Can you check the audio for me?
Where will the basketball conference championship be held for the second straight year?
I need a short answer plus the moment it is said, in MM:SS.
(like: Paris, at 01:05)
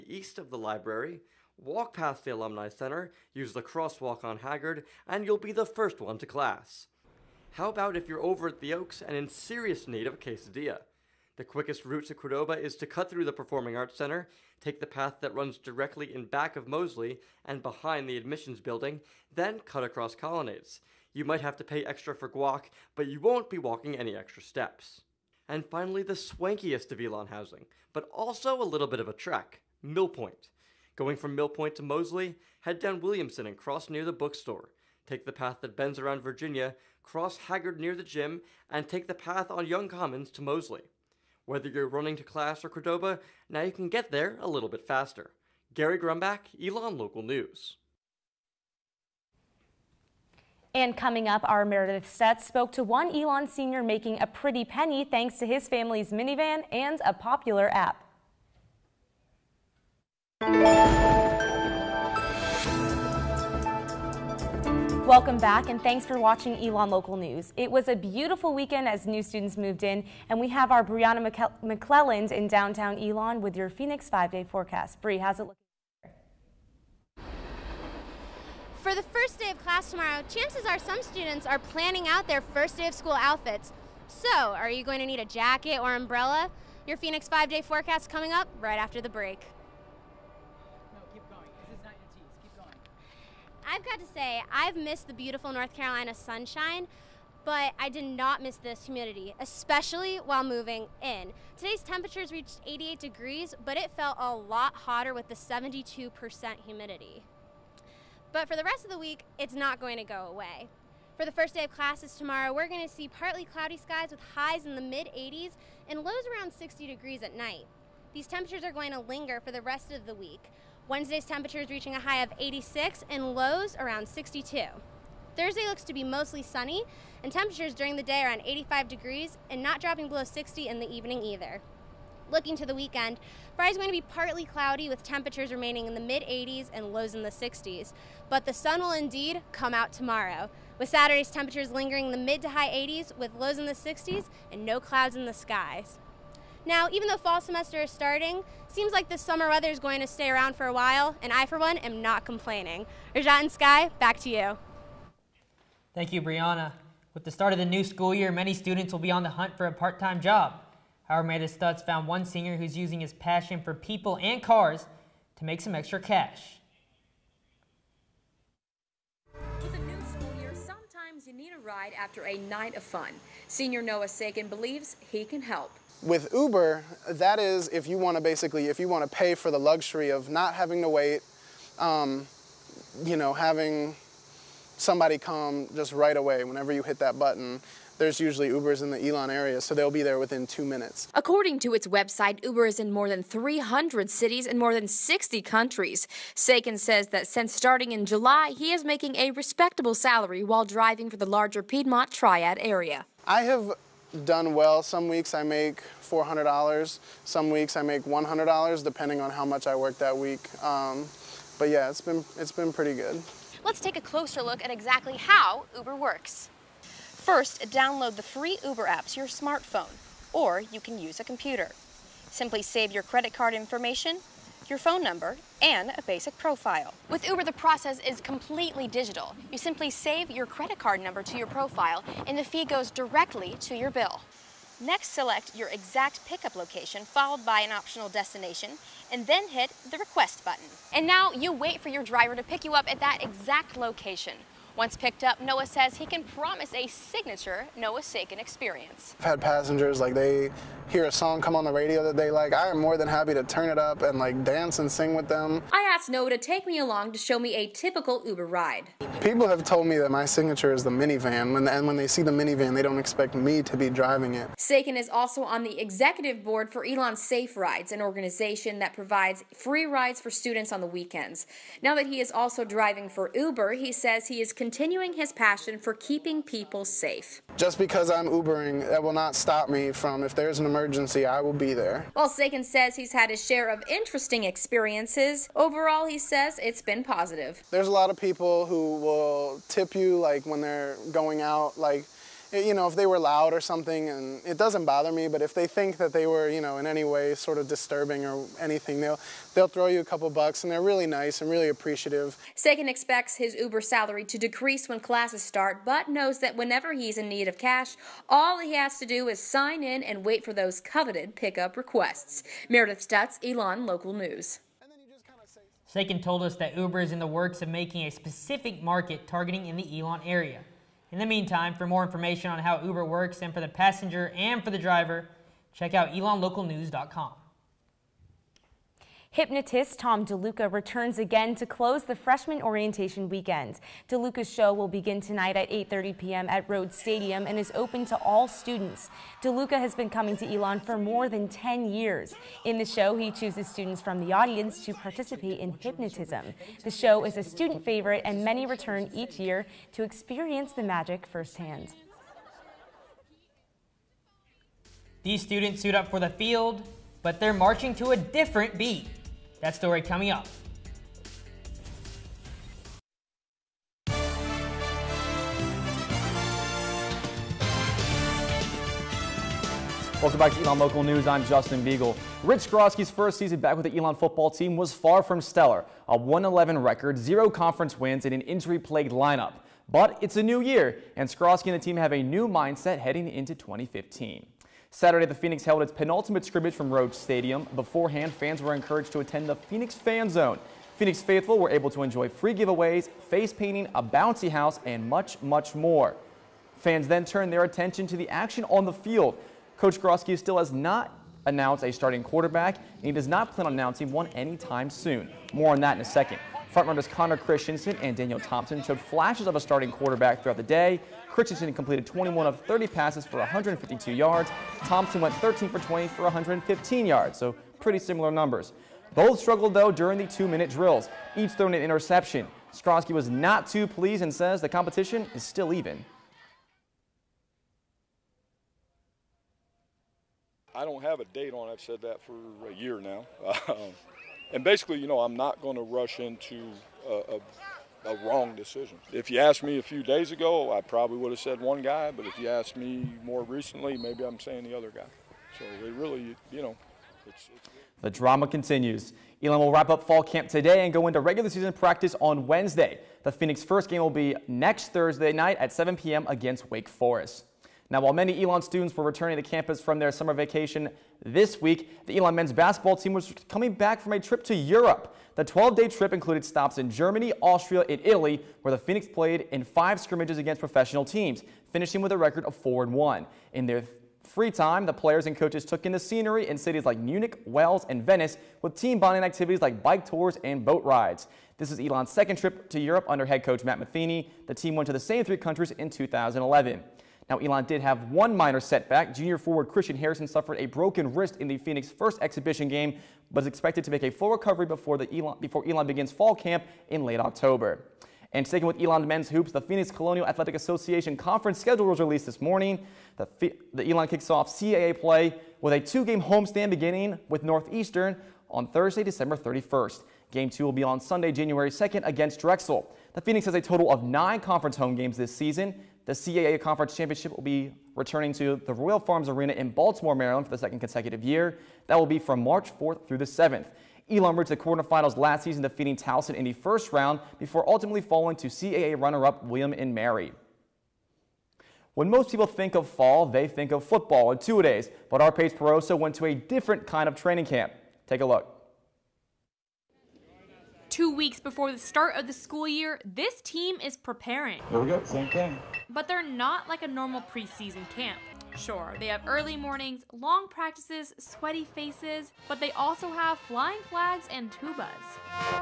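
Royal Farms Arena, at 08:38.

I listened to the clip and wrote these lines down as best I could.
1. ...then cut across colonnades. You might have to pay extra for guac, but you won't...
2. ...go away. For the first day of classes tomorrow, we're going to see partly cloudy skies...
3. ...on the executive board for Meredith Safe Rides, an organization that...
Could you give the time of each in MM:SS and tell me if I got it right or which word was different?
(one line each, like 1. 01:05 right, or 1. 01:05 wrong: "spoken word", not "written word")
1. 00:19 right
2. 01:50 right
3. 04:25 wrong: "Elon", not "Meredith".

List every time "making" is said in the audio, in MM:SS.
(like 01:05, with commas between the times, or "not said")
00:53, 03:18, 05:17.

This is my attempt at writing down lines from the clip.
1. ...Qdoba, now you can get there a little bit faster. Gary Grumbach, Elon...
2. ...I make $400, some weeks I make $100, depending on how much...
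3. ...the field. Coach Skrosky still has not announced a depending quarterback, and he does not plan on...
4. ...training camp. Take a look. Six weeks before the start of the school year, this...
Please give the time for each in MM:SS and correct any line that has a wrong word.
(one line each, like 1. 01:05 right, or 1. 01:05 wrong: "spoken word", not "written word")
1. 00:42 right
2. 03:25 right
3. 06:38 wrong: "starting", not "depending"
4. 08:57 wrong: "Two", not "Six".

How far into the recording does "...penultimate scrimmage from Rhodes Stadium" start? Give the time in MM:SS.
06:25.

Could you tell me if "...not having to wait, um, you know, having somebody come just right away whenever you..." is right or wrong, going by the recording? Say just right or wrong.
right.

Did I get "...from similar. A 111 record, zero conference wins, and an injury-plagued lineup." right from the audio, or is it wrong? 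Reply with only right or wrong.
wrong.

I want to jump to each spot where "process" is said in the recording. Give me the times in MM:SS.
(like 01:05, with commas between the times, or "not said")
03:47.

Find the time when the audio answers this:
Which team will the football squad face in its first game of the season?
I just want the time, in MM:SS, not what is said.
07:36.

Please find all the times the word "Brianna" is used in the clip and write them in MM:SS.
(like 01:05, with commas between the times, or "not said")
01:10, 02:36.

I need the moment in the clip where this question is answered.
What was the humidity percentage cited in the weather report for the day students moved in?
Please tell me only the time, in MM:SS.
01:45.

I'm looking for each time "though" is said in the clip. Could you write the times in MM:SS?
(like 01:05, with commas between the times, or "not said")
02:27, 06:59.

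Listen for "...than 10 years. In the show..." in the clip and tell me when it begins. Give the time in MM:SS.
05:41.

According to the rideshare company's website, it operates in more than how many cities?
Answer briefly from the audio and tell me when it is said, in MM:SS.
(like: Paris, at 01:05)
300, at 03:13.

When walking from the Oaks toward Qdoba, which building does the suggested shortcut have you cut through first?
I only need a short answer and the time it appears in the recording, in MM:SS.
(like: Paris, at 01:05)
Performing Arts Center, at 00:13.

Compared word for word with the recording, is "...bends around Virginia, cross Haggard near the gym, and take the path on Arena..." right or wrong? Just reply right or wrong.
wrong.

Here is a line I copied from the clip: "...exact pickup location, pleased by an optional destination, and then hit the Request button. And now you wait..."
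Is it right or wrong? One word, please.
wrong.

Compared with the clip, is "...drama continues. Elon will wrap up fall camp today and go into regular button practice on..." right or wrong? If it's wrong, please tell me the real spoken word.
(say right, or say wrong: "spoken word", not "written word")
wrong: "season", not "button".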